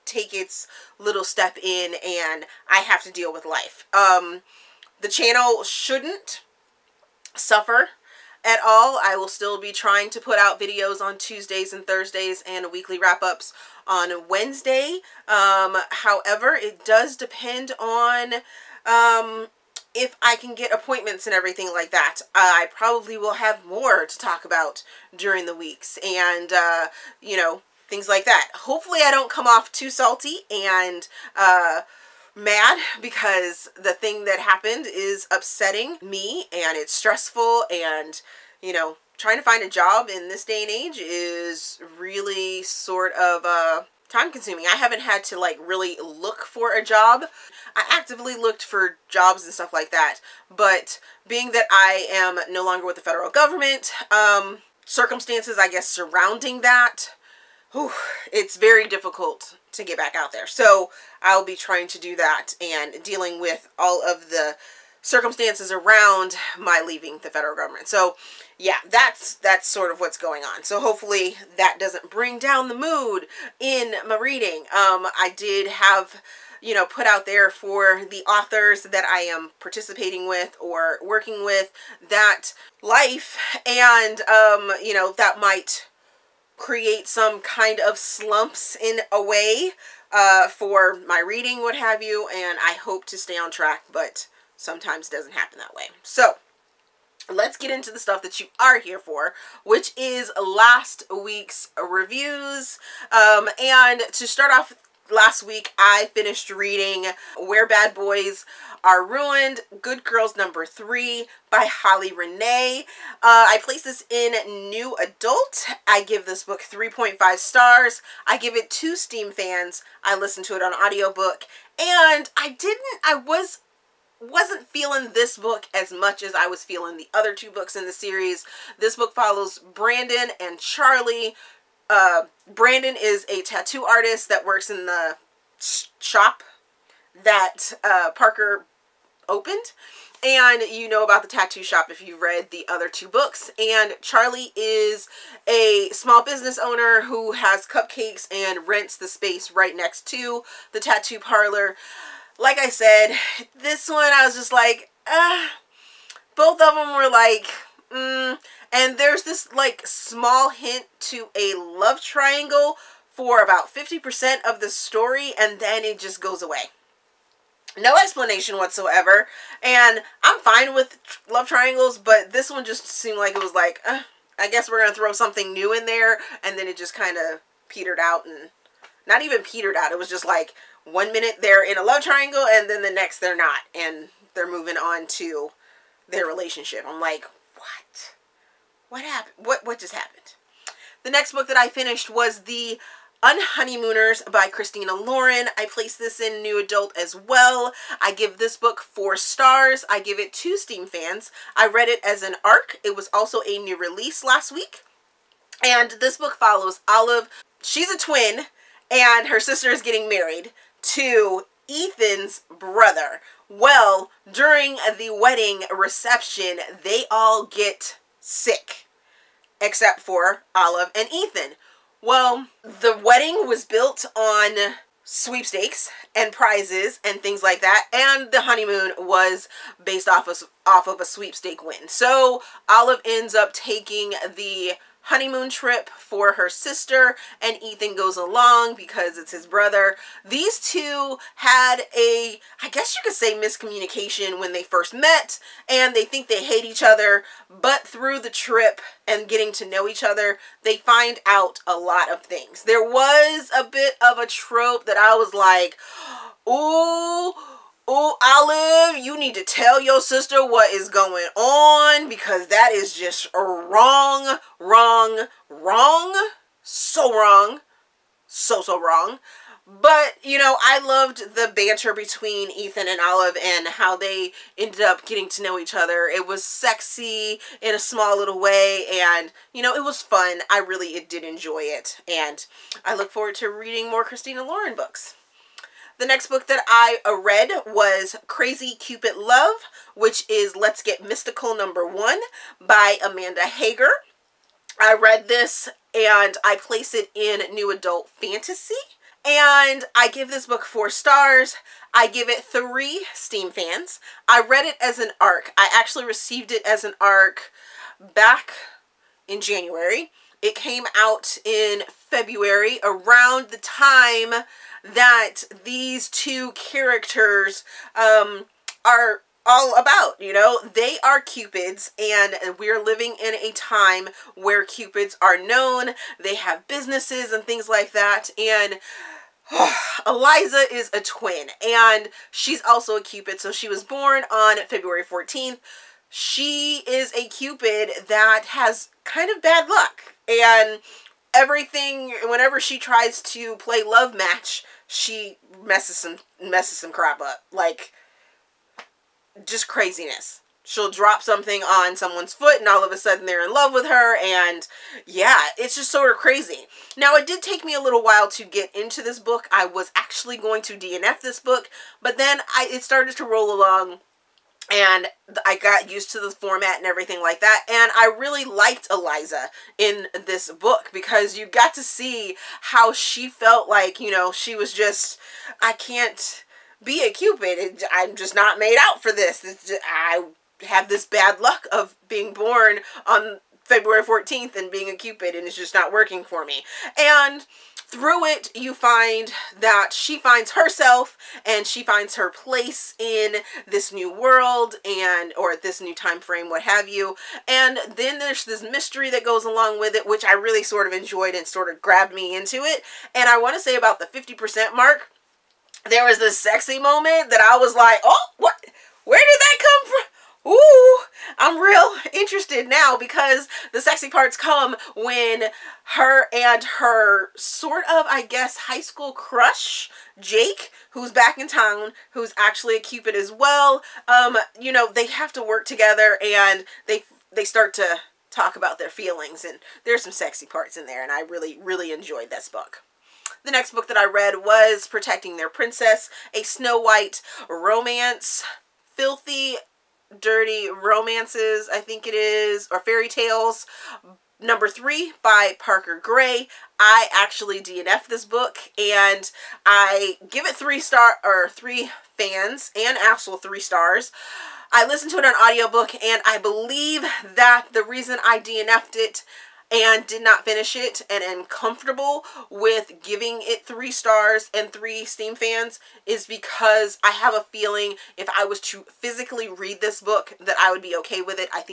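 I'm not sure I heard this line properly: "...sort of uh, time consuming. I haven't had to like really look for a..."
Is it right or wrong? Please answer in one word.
right.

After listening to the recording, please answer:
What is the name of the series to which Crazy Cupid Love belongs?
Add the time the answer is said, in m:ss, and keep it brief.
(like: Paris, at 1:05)
Let's Get Mystical, at 4:50.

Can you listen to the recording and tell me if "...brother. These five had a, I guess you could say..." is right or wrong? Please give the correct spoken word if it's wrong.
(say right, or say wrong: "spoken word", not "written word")
wrong: "two", not "five".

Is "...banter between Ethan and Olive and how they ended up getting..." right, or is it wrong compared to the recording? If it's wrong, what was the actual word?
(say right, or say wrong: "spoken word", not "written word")
right.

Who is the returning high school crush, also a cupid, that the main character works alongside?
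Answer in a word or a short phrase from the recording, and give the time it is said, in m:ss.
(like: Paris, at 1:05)
Jake, at 7:00.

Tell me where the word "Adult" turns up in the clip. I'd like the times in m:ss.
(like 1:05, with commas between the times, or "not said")
1:54, 3:16, 4:57.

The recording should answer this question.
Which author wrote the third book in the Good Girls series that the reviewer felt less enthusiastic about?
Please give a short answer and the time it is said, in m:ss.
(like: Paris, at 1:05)
Holly Renee, at 1:51.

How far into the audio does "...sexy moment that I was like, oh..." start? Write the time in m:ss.
6:46.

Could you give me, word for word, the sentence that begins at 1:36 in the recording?
So let's get into the stuff that you are here for, which is last week's reviews.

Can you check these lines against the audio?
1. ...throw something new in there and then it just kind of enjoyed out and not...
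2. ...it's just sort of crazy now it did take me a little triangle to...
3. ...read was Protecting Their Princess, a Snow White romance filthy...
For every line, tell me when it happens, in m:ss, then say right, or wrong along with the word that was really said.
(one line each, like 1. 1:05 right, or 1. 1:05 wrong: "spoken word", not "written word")
1. 2:54 wrong: "petered", not "enjoyed"
2. 5:55 wrong: "while", not "triangle"
3. 7:14 right.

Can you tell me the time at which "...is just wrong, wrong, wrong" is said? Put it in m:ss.
4:22.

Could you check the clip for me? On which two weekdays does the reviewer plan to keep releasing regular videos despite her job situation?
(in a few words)
Tuesdays and Thursdays.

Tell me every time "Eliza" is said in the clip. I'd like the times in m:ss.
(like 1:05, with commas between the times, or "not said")
5:30, 6:08.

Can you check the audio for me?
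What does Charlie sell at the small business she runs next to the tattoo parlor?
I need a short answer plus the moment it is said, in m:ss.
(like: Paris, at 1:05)
cupcakes, at 2:27.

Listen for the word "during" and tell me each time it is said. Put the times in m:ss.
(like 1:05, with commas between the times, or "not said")
0:25, 3:34.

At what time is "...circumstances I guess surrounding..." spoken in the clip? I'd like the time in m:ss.
0:54.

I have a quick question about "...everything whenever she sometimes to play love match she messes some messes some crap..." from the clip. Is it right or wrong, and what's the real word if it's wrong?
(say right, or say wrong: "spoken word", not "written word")
wrong: "tries", not "sometimes".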